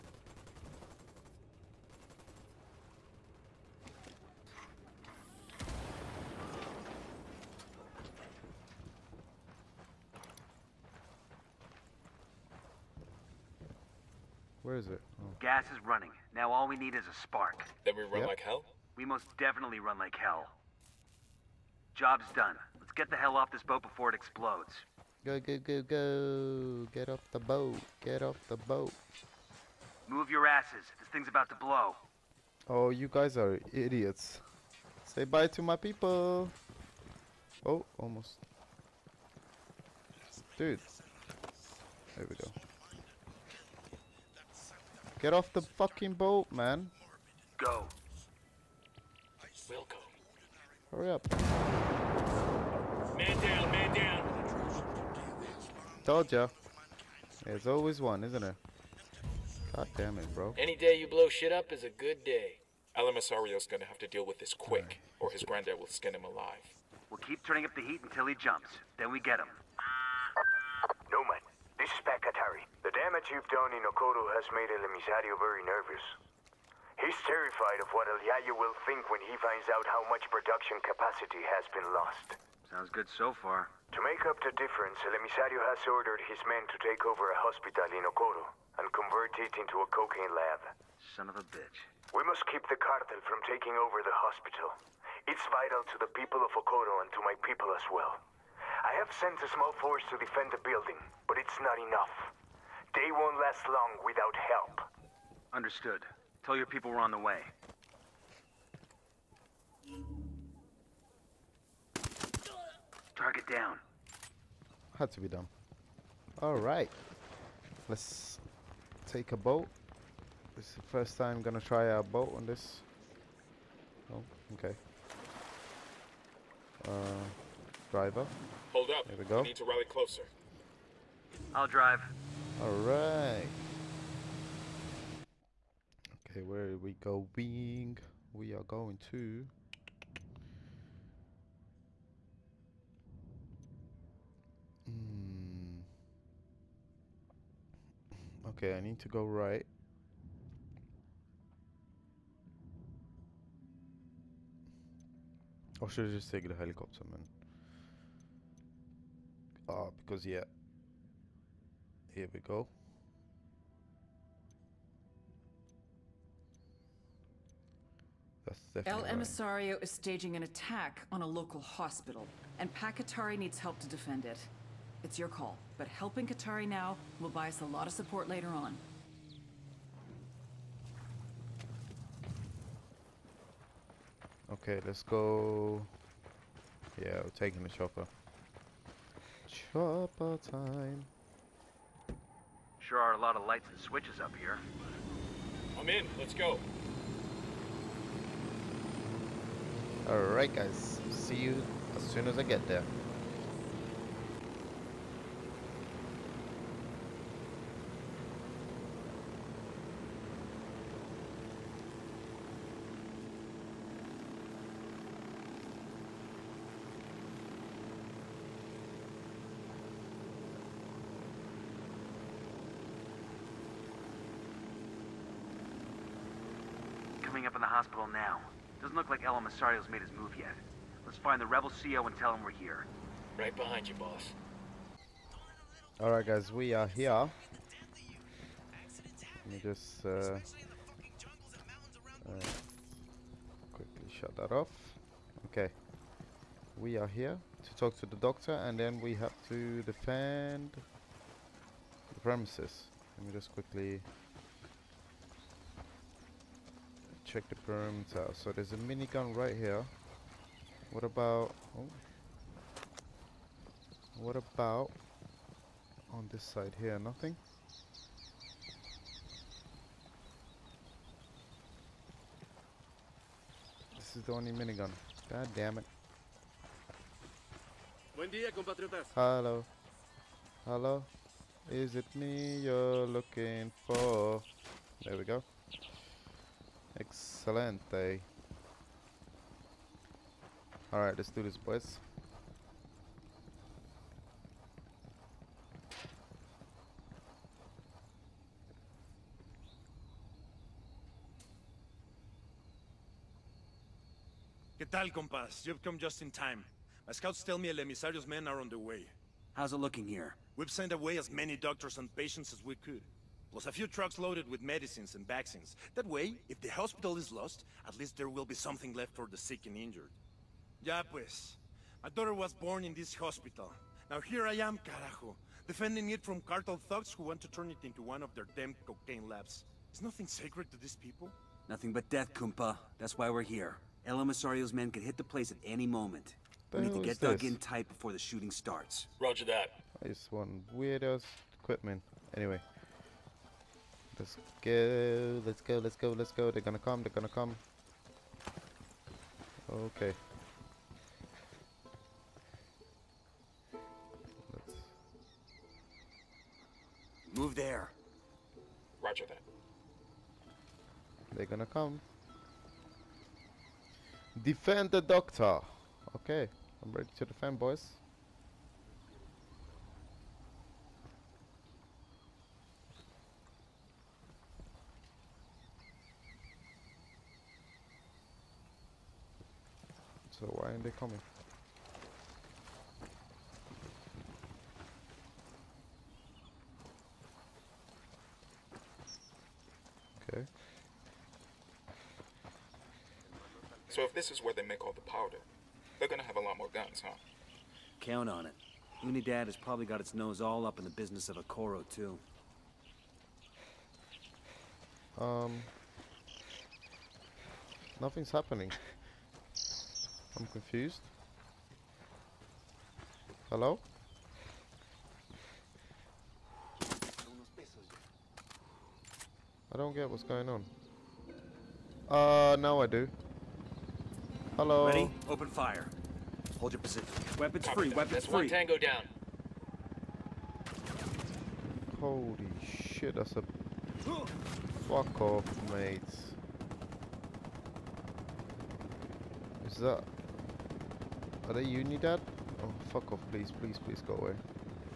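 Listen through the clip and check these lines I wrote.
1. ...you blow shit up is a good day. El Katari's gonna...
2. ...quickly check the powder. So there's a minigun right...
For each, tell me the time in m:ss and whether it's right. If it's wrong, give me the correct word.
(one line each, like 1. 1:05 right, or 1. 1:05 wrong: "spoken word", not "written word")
1. 1:00 wrong: "Emisario", not "Katari"
2. 4:13 wrong: "perimeter", not "powder".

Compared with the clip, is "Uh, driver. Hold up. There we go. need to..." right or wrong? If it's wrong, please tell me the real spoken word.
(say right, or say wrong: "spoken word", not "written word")
right.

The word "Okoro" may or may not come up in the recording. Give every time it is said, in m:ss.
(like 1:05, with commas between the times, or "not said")
1:28, 1:36, 6:41.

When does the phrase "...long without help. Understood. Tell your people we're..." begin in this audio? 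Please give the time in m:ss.
1:43.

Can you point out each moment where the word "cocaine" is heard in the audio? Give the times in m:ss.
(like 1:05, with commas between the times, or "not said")
1:29, 5:28.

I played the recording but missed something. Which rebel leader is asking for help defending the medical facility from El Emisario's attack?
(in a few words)
Pac Katari.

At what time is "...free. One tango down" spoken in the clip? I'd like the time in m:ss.
7:08.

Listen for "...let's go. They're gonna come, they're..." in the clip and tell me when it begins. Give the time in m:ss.
5:46.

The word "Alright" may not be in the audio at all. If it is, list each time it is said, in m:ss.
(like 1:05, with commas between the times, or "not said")
1:56, 2:12, 3:20, 3:56, 4:50.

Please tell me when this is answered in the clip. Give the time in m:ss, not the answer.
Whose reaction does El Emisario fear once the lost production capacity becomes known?
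1:18.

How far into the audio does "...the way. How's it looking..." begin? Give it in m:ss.
5:08.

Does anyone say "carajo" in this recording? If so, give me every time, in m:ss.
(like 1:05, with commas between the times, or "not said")
5:24.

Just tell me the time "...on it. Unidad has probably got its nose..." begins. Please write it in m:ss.
6:38.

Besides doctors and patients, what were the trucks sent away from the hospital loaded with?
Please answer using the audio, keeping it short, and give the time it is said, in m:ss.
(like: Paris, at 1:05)
Medicines and vaccines, at 5:14.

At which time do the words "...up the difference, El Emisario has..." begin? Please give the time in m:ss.
1:24.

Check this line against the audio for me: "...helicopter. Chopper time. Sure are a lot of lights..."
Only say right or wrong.
wrong.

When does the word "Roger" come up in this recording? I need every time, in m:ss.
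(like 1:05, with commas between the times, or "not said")
5:39, 5:59.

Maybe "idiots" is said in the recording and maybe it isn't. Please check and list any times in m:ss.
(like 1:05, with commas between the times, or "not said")
0:33.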